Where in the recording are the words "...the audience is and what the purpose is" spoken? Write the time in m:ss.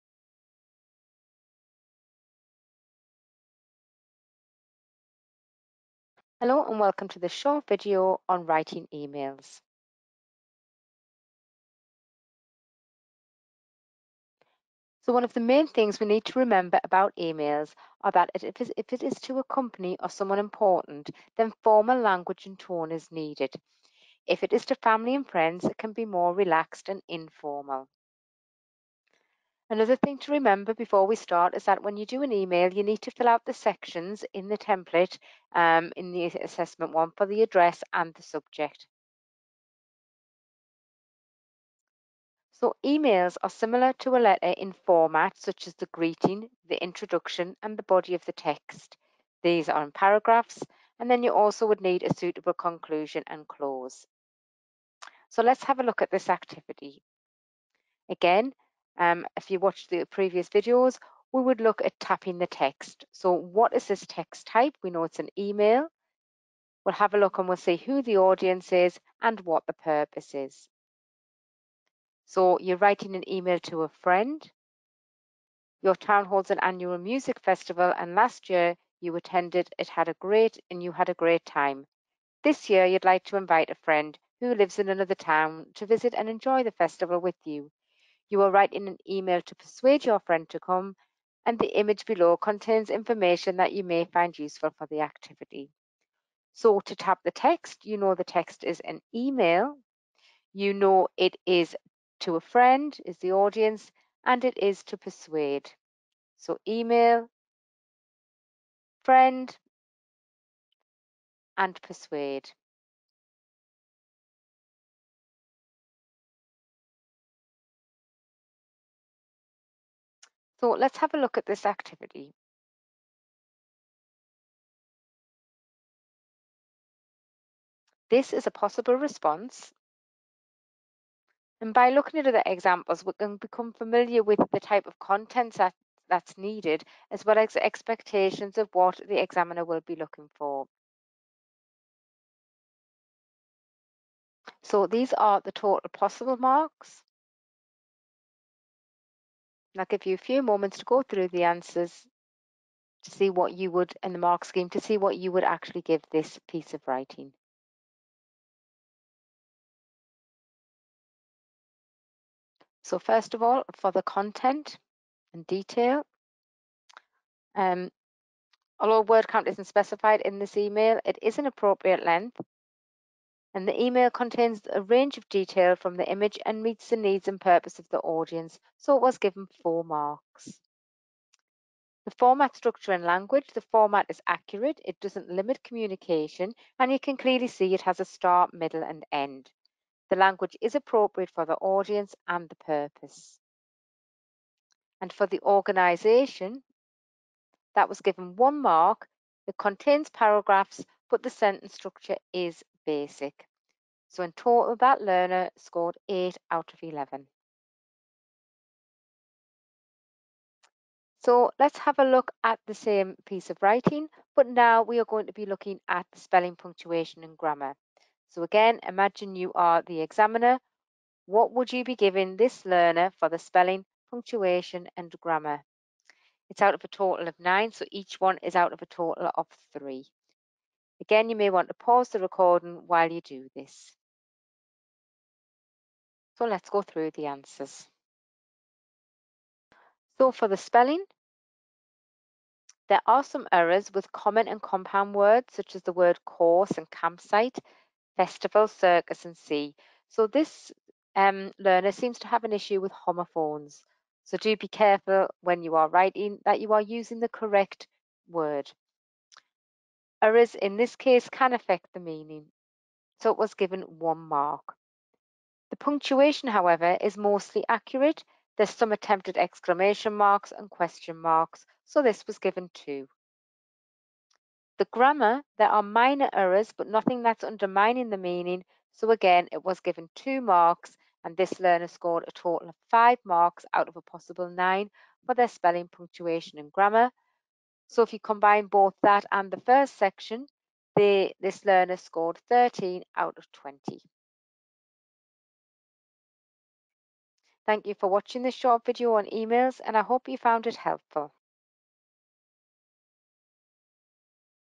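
1:08.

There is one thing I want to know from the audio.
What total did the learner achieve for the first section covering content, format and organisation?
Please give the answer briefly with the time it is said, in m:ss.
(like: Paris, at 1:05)
8 out of 11, at 3:26.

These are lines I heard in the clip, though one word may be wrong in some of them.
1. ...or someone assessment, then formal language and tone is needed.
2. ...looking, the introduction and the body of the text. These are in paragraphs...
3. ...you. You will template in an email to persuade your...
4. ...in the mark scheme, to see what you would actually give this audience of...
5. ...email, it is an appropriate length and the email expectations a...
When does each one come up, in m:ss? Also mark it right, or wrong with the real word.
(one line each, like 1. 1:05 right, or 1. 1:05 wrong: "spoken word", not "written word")
1. 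0:19 wrong: "important", not "assessment"
2. 0:45 wrong: "greeting", not "looking"
3. 1:27 wrong: "write", not "template"
4. 2:34 wrong: "piece", not "audience"
5. 2:50 wrong: "contains", not "expectations".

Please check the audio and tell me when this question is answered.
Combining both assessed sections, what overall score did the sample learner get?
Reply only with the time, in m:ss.
4:52.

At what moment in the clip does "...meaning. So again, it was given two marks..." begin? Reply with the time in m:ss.
4:38.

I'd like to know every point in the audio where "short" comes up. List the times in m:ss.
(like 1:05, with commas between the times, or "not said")
0:07, 4:58.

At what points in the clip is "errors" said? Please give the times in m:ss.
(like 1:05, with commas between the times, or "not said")
4:03, 4:20, 4:36.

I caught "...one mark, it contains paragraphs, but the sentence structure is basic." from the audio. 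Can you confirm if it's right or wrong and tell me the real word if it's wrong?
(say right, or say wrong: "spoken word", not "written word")
right.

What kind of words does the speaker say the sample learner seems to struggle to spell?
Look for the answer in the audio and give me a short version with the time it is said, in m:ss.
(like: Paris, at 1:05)
homophones, at 4:12.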